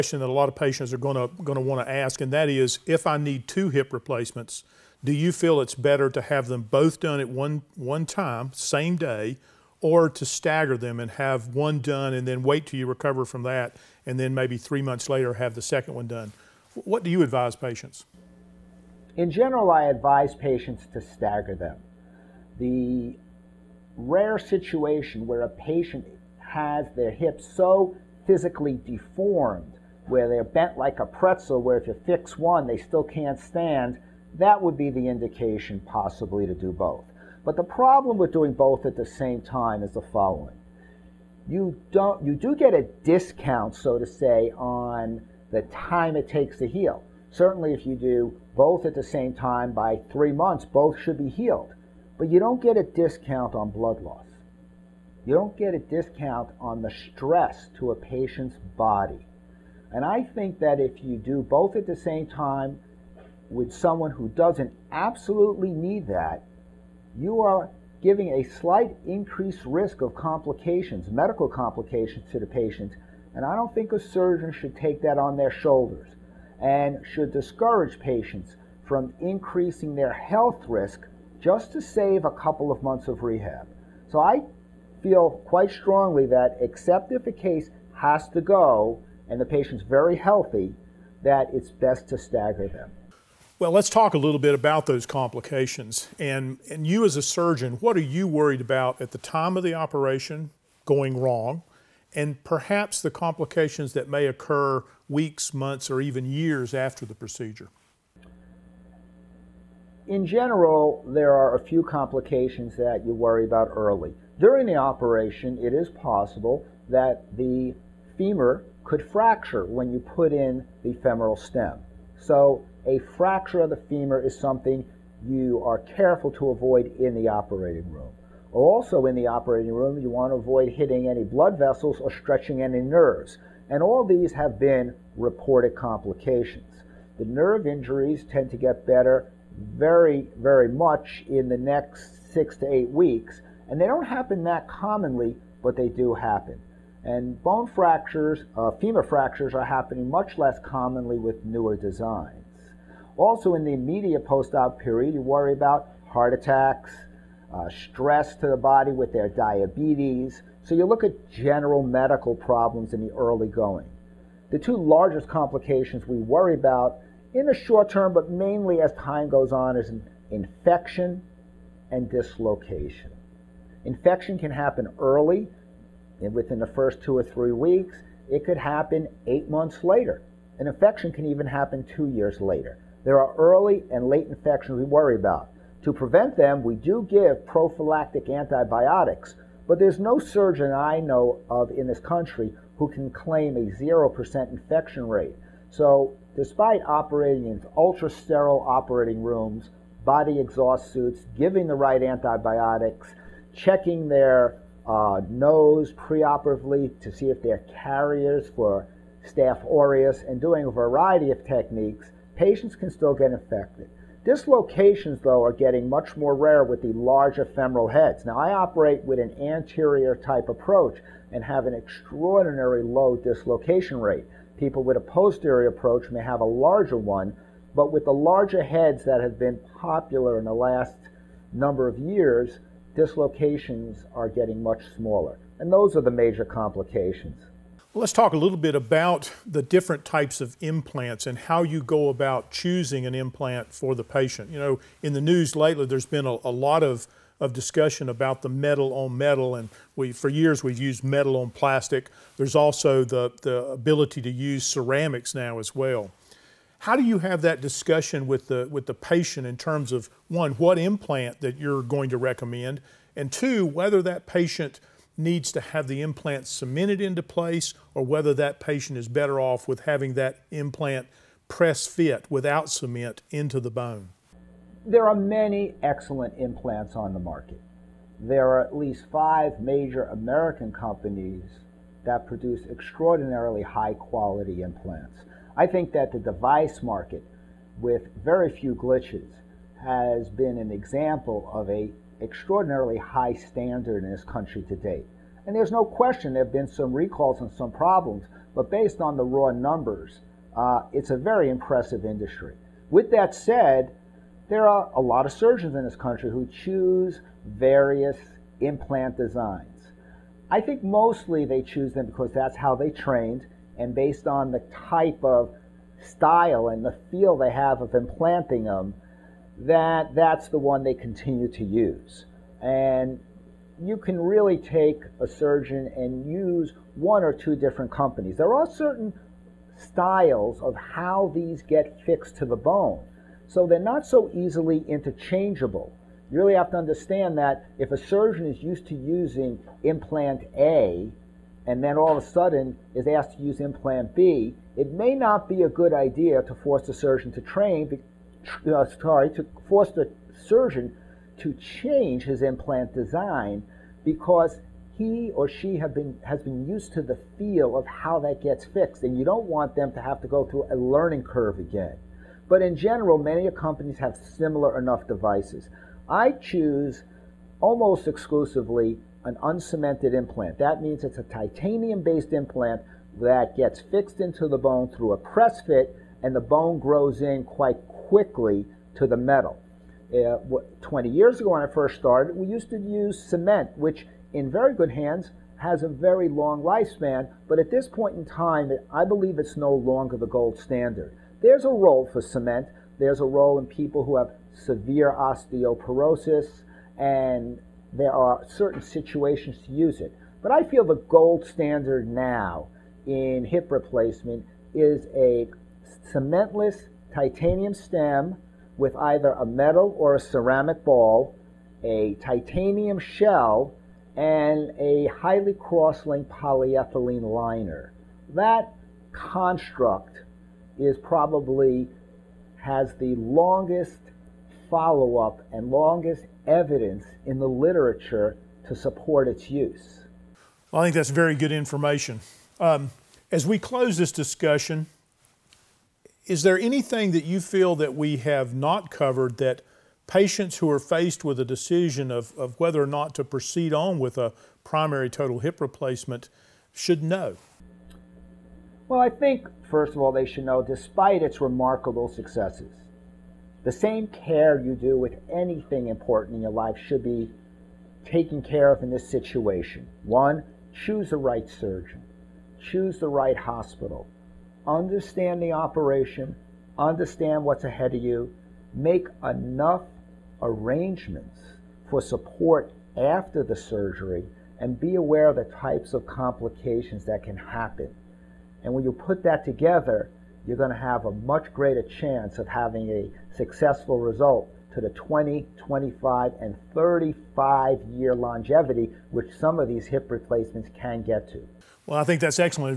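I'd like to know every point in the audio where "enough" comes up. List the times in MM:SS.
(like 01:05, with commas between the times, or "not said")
06:04, 07:49.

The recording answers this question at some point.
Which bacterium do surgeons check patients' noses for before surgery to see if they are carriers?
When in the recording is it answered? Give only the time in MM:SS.
03:29.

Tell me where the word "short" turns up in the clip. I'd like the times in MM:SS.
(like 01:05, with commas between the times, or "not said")
02:47.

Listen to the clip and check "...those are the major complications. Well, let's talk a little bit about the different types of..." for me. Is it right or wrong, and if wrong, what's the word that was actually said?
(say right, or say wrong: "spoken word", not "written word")
right.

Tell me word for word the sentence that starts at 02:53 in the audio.
Infection can happen early, within the first two or three weeks.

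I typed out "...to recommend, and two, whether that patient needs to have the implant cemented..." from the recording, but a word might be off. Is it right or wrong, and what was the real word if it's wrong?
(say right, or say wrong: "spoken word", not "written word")
right.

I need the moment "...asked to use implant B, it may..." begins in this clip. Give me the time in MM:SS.
05:43.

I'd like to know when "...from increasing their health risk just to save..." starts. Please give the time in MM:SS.
01:18.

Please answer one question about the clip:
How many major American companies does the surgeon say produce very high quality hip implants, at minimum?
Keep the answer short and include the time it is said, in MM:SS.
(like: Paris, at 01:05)
5, at 04:39.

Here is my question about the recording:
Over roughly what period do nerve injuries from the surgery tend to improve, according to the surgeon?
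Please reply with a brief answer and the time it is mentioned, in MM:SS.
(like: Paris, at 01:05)
6 to 8 weeks, at 02:22.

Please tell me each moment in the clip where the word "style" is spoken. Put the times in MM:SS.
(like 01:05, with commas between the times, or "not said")
05:16, 05:29.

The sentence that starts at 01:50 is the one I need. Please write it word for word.
In general, there are a few complications that you worry about early.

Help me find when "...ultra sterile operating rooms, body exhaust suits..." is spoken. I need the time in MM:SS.
03:17.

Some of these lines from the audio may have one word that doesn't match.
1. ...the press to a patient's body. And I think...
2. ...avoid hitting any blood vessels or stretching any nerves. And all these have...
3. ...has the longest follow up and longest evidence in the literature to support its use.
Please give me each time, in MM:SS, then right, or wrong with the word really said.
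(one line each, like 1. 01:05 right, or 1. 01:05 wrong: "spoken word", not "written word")
1. 00:56 wrong: "stress", not "press"
2. 02:10 right
3. 07:02 right.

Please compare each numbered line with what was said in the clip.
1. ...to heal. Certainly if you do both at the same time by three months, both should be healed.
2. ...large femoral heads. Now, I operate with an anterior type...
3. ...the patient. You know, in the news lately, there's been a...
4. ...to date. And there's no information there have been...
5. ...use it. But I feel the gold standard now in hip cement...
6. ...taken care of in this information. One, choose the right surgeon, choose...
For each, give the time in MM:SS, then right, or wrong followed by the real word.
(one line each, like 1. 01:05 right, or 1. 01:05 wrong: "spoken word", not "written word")
1. 00:46 right
2. 03:36 right
3. 04:03 right
4. 04:54 wrong: "question", not "information"
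5. 06:39 wrong: "replacement", not "cement"
6. 07:38 wrong: "situation", not "information".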